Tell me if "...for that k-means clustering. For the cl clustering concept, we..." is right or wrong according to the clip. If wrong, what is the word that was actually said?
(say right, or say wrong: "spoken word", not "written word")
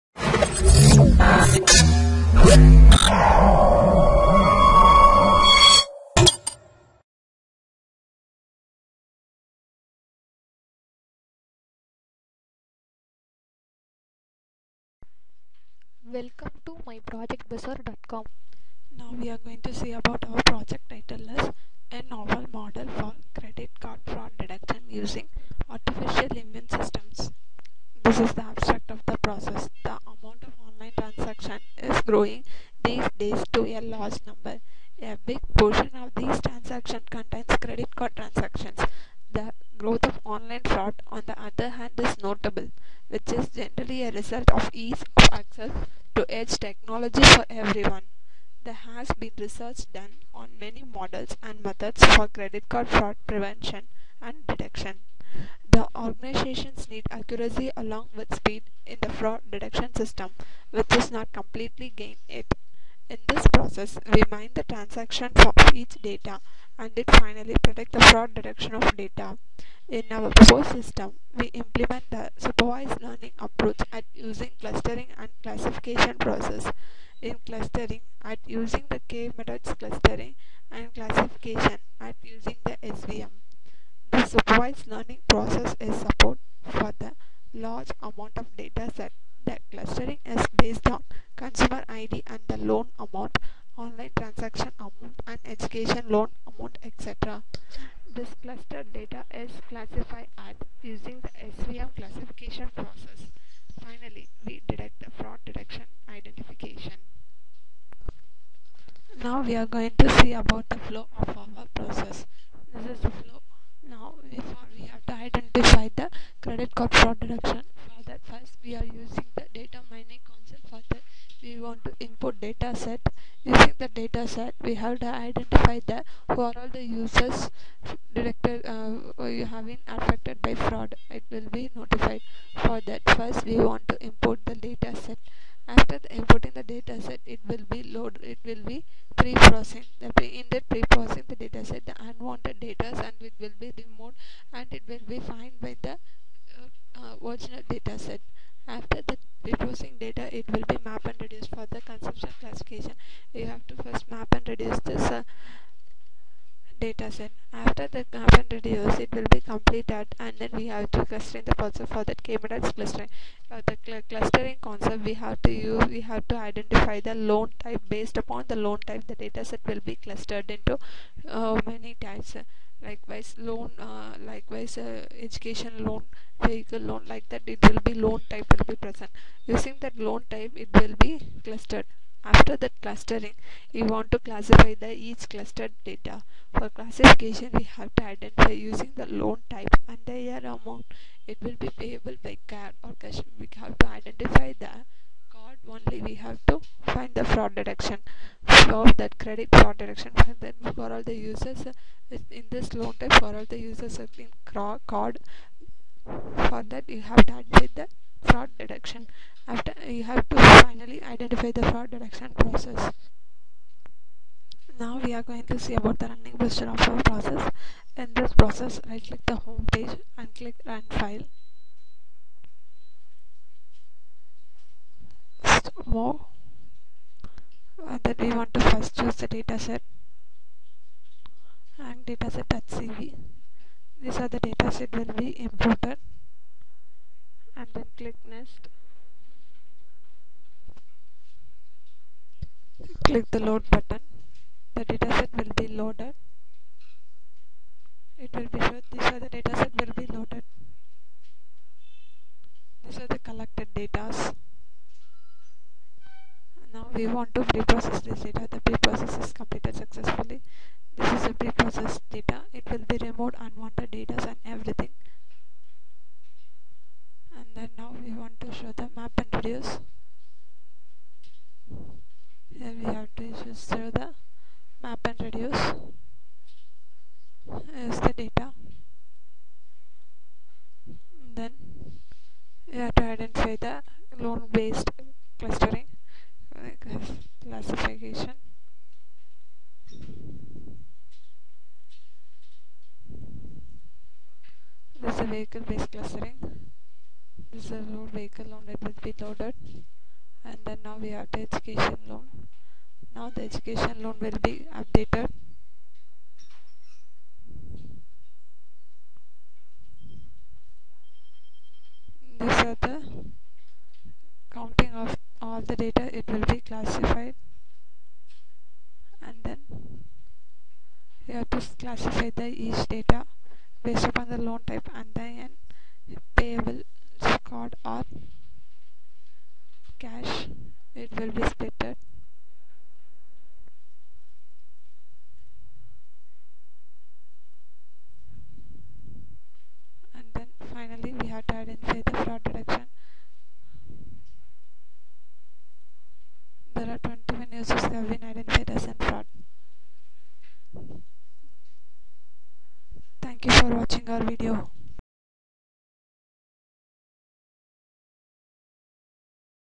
right.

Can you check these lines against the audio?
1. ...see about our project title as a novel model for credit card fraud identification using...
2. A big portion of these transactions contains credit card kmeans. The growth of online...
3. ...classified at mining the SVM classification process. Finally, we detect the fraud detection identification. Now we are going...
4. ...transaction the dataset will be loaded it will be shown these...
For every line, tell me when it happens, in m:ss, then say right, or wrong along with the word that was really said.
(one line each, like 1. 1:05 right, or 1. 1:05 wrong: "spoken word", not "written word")
1. 0:19 wrong: "detection", not "identification"
2. 0:35 wrong: "transactions", not "kmeans"
3. 1:39 wrong: "using", not "mining"
4. 4:03 wrong: "button", not "transaction".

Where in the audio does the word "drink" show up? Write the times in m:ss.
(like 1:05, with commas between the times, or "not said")
not said.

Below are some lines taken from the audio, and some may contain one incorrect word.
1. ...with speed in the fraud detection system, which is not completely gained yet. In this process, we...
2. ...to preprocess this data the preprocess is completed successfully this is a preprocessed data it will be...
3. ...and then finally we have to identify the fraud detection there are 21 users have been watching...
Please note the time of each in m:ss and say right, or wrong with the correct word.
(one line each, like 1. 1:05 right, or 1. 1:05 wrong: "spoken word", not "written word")
1. 0:58 right
2. 4:17 right
3. 5:40 right.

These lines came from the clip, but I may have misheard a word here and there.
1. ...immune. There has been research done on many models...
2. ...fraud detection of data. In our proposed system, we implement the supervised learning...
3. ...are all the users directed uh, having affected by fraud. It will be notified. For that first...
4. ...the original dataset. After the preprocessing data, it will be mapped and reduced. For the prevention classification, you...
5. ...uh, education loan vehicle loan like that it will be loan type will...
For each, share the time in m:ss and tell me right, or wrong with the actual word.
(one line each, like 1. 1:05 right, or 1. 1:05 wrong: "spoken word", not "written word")
1. 0:47 wrong: "everyone", not "immune"
2. 1:08 right
3. 2:06 right
4. 2:25 wrong: "consumption", not "prevention"
5. 2:54 right.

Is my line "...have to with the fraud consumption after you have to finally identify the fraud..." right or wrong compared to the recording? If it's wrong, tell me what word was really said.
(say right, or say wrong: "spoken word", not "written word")
wrong: "detection", not "consumption".